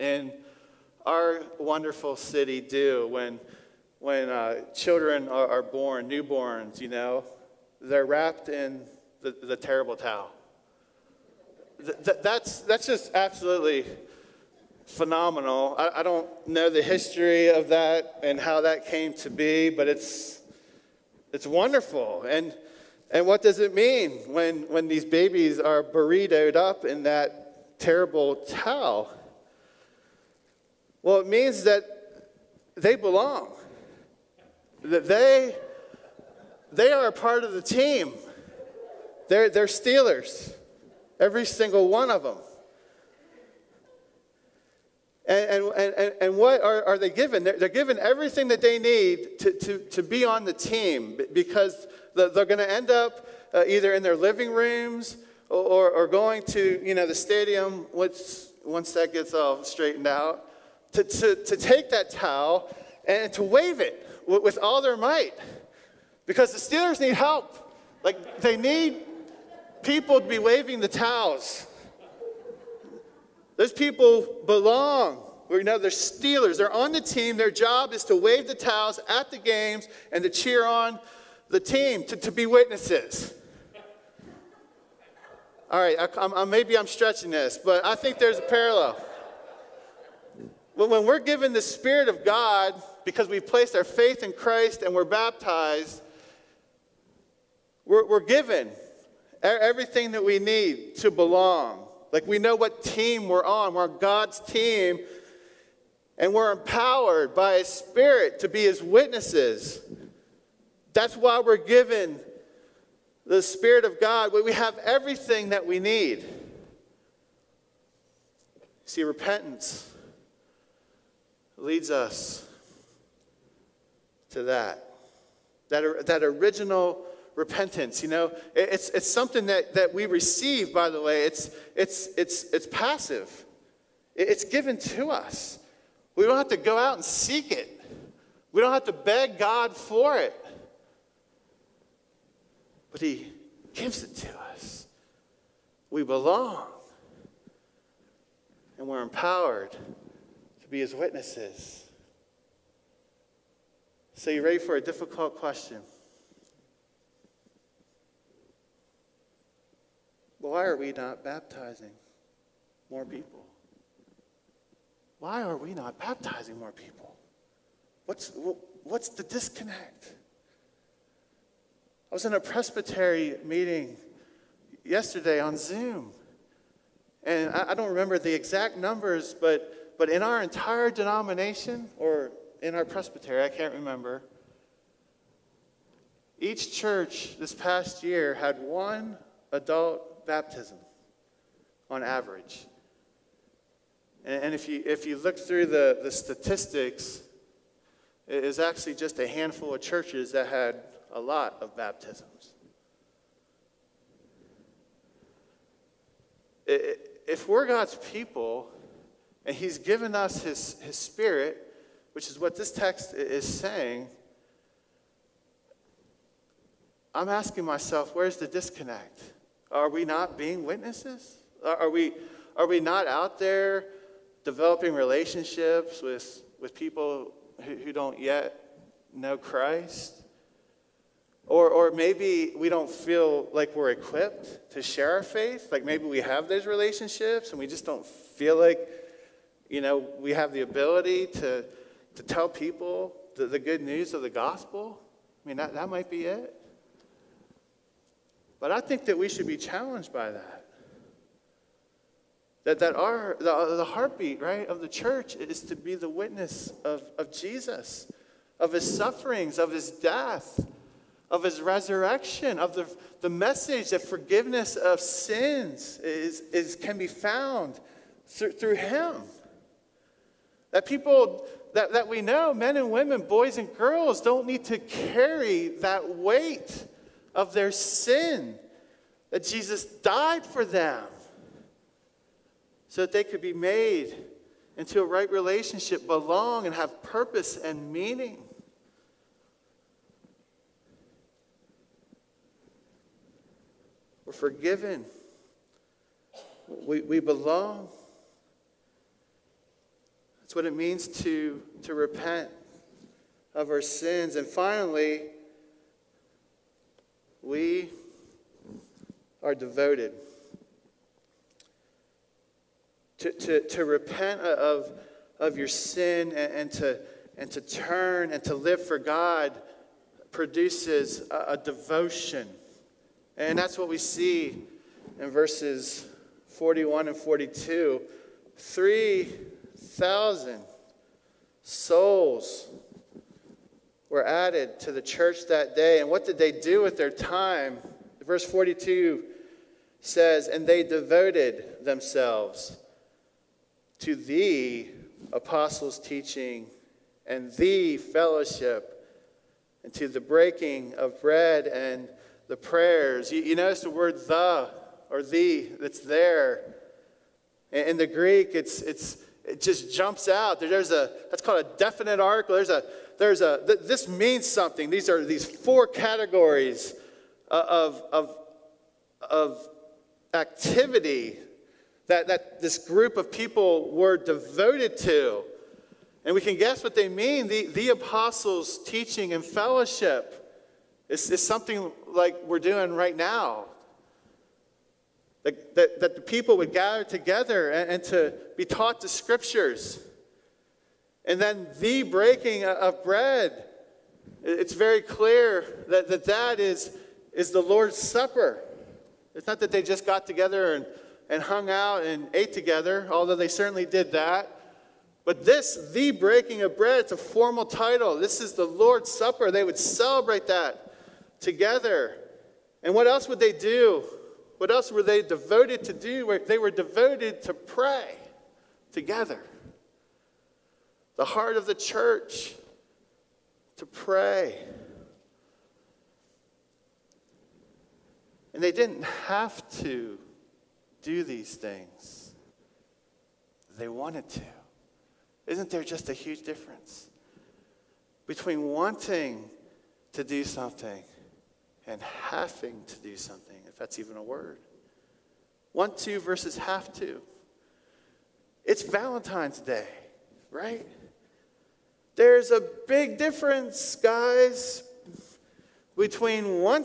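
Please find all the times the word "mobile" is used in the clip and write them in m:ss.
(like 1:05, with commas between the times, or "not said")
not said.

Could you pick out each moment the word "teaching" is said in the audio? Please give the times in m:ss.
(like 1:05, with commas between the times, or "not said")
5:45, 6:18.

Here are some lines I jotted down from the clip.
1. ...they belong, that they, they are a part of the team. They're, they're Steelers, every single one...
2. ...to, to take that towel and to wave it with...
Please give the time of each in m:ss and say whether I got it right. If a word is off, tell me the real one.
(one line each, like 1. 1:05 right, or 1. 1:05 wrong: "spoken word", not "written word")
1. 0:32 right
2. 1:01 right.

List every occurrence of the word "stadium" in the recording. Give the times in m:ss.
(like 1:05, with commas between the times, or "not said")
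0:57.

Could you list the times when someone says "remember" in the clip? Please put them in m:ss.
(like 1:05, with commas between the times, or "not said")
2:57, 3:03.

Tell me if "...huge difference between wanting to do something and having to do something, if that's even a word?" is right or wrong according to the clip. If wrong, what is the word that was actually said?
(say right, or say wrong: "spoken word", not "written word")
right.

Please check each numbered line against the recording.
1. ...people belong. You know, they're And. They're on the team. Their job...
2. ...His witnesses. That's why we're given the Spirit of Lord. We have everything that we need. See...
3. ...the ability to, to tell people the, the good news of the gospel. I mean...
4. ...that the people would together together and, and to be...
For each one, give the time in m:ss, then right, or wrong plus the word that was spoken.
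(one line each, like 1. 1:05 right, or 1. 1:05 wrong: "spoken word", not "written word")
1. 1:13 wrong: "Steelers", not "And"
2. 1:48 wrong: "God", not "Lord"
3. 4:00 right
4. 6:26 wrong: "gather", not "together".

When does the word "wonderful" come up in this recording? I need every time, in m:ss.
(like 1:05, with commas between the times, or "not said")
0:01, 0:21.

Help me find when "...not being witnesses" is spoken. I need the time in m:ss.
3:40.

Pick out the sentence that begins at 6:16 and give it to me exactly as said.
And we can guess what they mean.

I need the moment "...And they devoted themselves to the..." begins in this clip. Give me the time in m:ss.
5:40.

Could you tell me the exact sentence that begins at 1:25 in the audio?
All right, I, I, maybe I'm stretching this, but I think there's a parallel.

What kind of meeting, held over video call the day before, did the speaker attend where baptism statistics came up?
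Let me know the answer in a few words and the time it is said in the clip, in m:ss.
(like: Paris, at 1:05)
presbytery meeting, at 2:52.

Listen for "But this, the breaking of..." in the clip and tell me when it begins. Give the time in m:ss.
6:45.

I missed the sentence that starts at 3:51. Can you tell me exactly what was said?
Or, or maybe we don't feel like we're equipped to share our faith.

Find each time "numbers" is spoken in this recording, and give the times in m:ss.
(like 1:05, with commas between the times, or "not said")
2:58.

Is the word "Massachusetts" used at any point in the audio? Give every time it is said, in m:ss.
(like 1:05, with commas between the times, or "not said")
not said.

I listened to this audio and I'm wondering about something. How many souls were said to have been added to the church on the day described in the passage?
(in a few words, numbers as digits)
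3,000.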